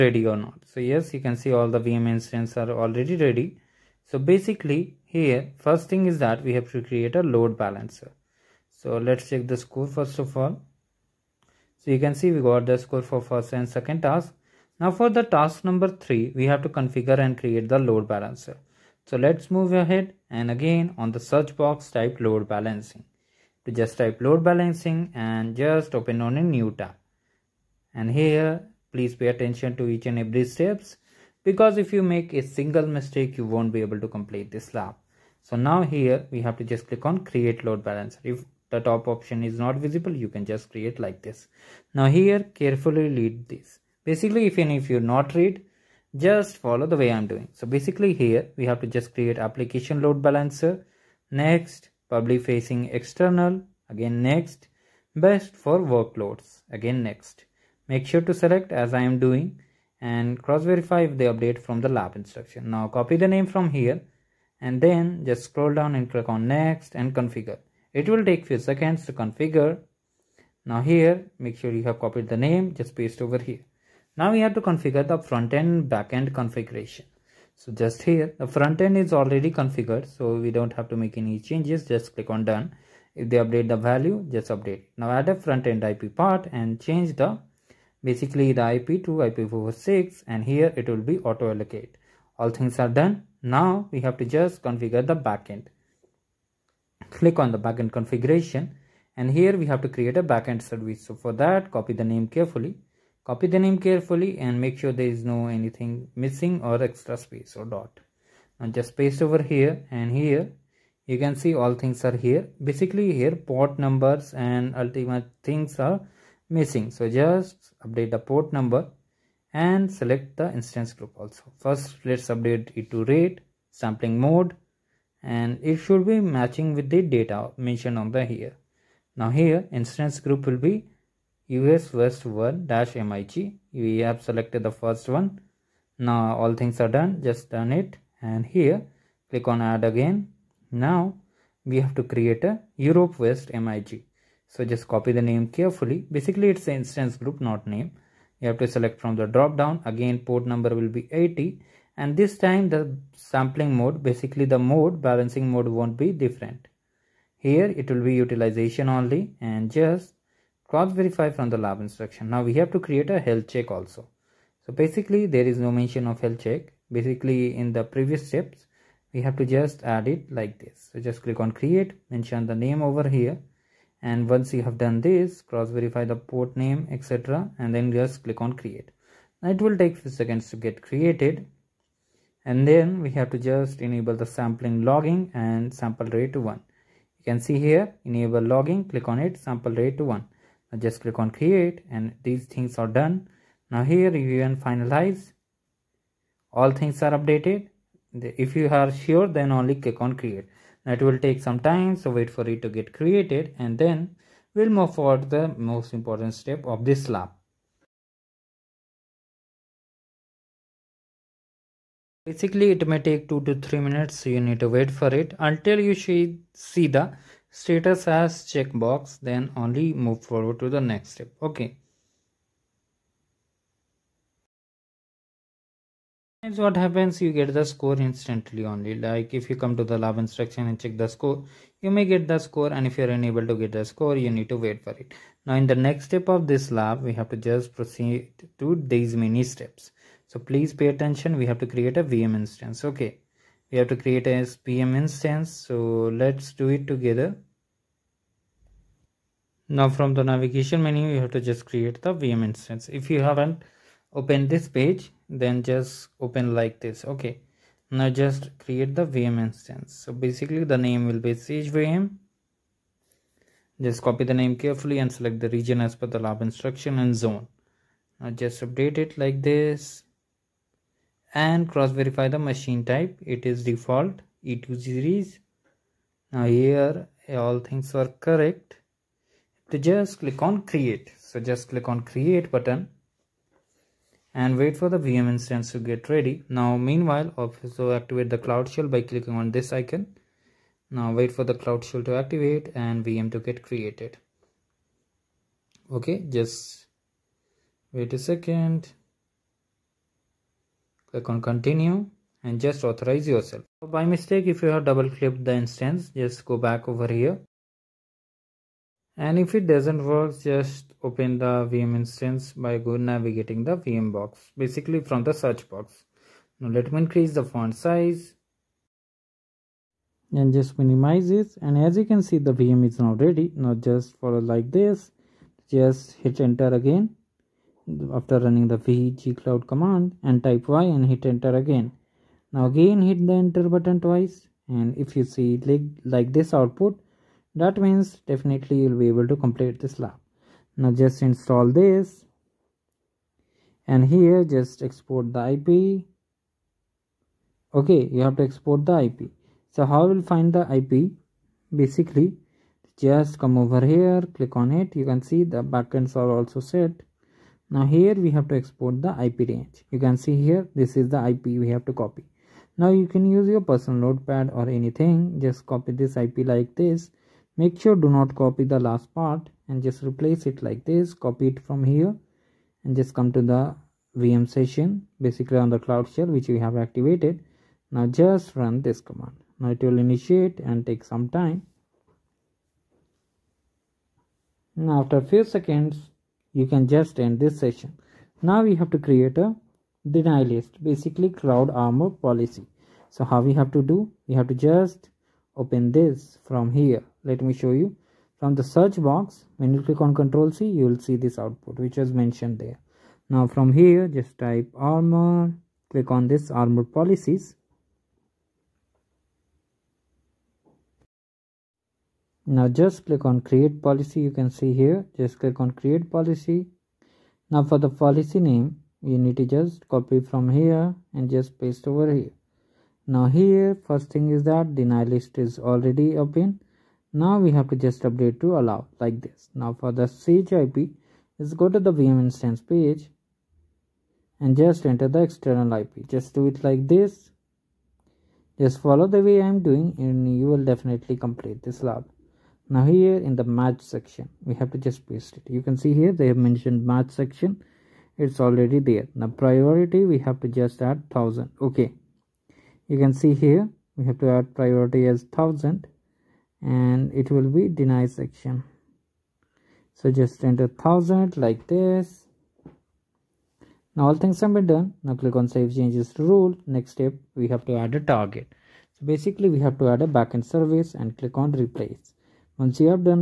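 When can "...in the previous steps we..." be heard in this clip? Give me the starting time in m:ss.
2:47.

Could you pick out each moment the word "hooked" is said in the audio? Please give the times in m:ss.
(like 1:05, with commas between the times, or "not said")
not said.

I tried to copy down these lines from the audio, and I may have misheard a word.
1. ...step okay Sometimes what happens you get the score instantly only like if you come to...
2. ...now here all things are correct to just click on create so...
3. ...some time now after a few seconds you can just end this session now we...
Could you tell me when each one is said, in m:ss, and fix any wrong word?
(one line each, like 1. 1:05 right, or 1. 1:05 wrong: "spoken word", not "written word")
1. 3:41 right
2. 4:36 right
3. 6:21 right.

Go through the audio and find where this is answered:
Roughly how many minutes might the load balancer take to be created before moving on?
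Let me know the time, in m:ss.
3:33.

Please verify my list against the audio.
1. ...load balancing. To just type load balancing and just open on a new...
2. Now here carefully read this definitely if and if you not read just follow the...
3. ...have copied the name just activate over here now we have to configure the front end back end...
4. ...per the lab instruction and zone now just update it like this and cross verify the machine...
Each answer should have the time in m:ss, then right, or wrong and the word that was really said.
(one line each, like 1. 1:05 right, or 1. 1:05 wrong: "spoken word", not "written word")
1. 0:22 right
2. 0:41 wrong: "basically", not "definitely"
3. 1:11 wrong: "paste", not "activate"
4. 4:25 right.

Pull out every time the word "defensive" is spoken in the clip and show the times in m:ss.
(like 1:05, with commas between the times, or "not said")
not said.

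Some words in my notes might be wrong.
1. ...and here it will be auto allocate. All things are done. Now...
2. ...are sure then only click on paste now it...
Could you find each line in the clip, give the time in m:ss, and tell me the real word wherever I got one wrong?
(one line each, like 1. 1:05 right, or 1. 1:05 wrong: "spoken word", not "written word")
1. 1:30 right
2. 3:18 wrong: "create", not "paste".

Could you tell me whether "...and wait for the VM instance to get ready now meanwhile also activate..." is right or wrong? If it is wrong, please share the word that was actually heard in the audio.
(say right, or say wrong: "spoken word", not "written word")
right.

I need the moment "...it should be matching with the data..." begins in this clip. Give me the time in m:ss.
2:05.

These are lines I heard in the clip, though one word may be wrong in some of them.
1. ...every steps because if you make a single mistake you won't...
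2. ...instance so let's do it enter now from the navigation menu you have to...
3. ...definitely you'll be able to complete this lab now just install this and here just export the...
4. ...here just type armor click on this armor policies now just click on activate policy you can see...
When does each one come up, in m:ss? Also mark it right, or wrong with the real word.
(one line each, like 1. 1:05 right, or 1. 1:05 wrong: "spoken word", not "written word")
1. 0:30 right
2. 4:05 wrong: "together", not "enter"
3. 5:38 right
4. 6:43 wrong: "create", not "activate".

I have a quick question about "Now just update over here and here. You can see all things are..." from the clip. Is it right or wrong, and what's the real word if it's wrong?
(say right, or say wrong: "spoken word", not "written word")
wrong: "paste", not "update".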